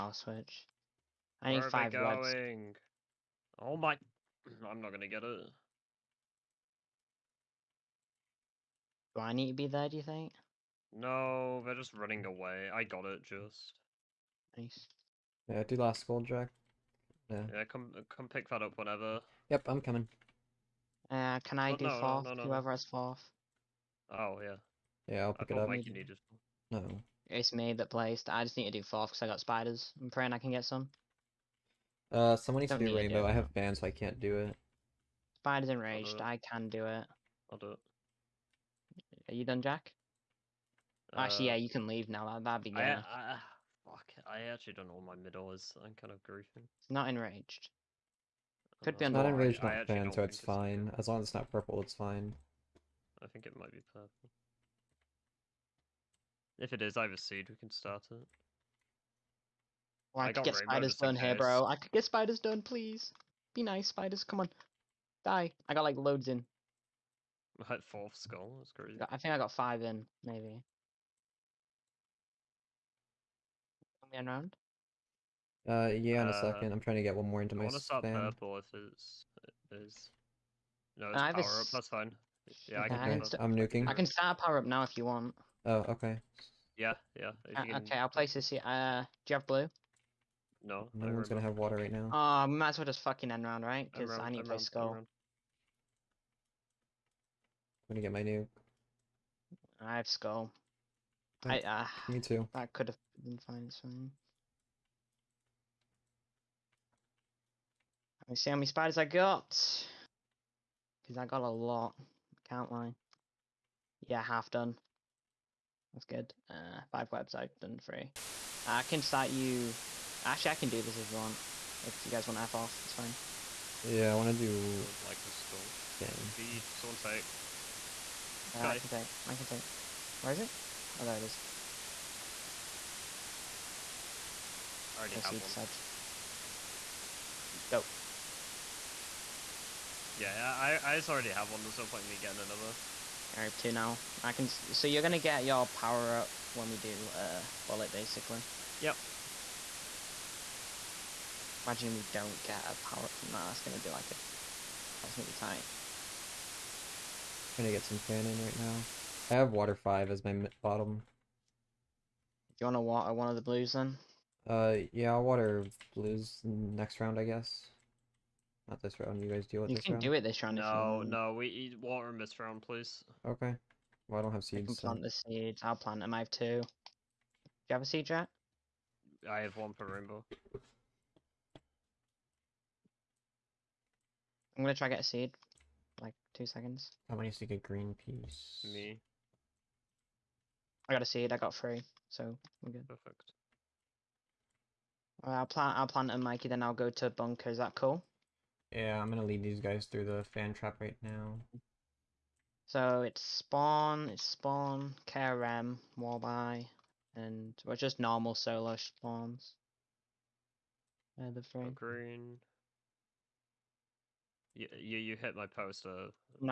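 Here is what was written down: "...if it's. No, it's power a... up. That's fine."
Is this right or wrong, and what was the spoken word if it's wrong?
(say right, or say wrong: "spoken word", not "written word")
right.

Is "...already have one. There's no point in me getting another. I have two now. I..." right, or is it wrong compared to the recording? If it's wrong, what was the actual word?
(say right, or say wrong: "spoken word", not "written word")
right.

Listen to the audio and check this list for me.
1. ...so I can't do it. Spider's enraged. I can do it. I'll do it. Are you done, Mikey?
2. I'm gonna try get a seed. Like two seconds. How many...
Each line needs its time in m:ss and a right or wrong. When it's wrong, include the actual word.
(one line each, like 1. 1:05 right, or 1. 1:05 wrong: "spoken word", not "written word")
1. 0:33 wrong: "Jack", not "Mikey"
2. 3:04 right.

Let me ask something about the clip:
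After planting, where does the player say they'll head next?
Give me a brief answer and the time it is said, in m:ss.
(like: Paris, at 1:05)
Bunker, at 3:16.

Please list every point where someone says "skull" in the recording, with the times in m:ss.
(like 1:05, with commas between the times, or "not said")
1:08, 1:34, 1:40, 2:05.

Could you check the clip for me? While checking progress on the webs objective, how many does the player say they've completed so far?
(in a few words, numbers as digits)
3.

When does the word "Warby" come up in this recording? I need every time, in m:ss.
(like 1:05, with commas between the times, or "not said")
3:25.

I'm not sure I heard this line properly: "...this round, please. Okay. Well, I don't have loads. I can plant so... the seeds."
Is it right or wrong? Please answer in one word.
wrong.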